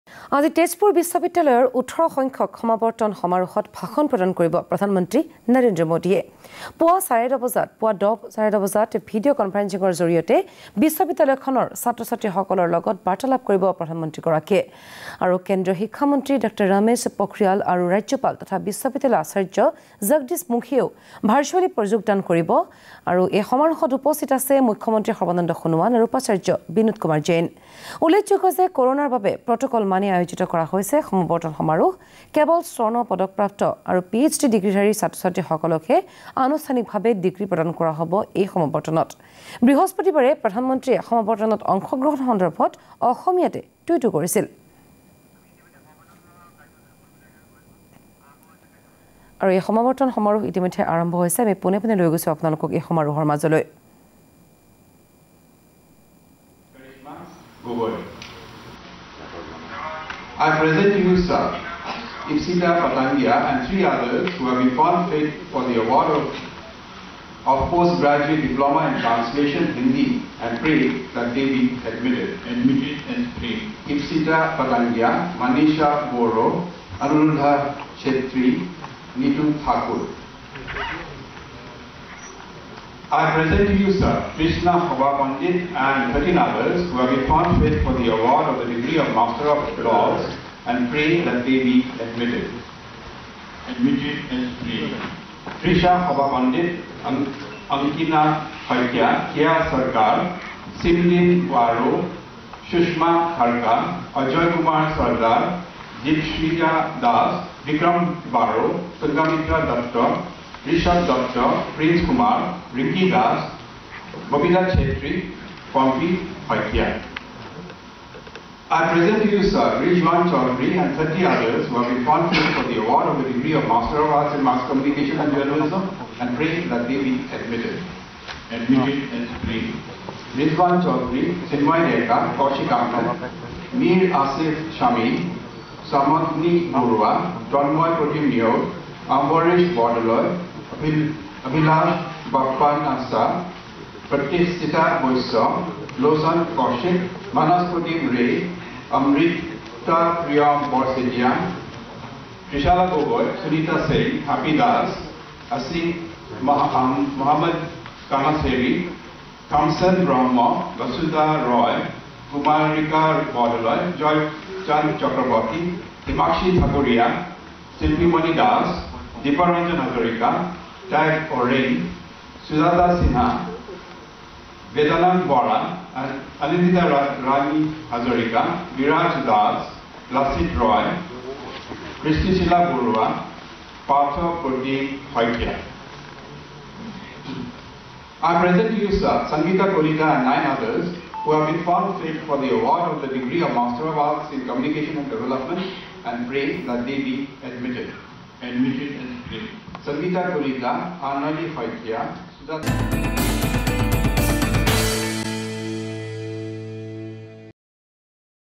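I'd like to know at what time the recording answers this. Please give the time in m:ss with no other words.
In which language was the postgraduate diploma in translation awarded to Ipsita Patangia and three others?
1:09.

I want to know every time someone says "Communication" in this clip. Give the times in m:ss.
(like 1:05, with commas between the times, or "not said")
2:04, 3:14.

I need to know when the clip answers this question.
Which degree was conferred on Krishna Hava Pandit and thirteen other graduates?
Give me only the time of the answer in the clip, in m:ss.
1:29.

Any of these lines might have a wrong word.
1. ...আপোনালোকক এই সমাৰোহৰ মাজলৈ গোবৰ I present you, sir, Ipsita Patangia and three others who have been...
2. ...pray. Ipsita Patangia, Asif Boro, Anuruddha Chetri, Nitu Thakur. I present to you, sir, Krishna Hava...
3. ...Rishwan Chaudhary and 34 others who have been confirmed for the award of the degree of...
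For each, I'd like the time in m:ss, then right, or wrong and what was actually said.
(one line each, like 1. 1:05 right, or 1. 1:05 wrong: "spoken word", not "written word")
1. 0:52 right
2. 1:13 wrong: "Manisha", not "Asif"
3. 1:59 wrong: "30", not "34".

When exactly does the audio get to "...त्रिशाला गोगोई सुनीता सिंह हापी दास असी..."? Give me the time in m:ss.
2:32.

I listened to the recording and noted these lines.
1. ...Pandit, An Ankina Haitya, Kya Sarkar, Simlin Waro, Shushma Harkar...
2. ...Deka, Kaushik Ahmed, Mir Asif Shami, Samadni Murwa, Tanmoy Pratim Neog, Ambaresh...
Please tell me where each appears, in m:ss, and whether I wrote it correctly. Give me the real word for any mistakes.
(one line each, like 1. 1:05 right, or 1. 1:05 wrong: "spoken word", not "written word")
1. 1:36 right
2. 2:12 right.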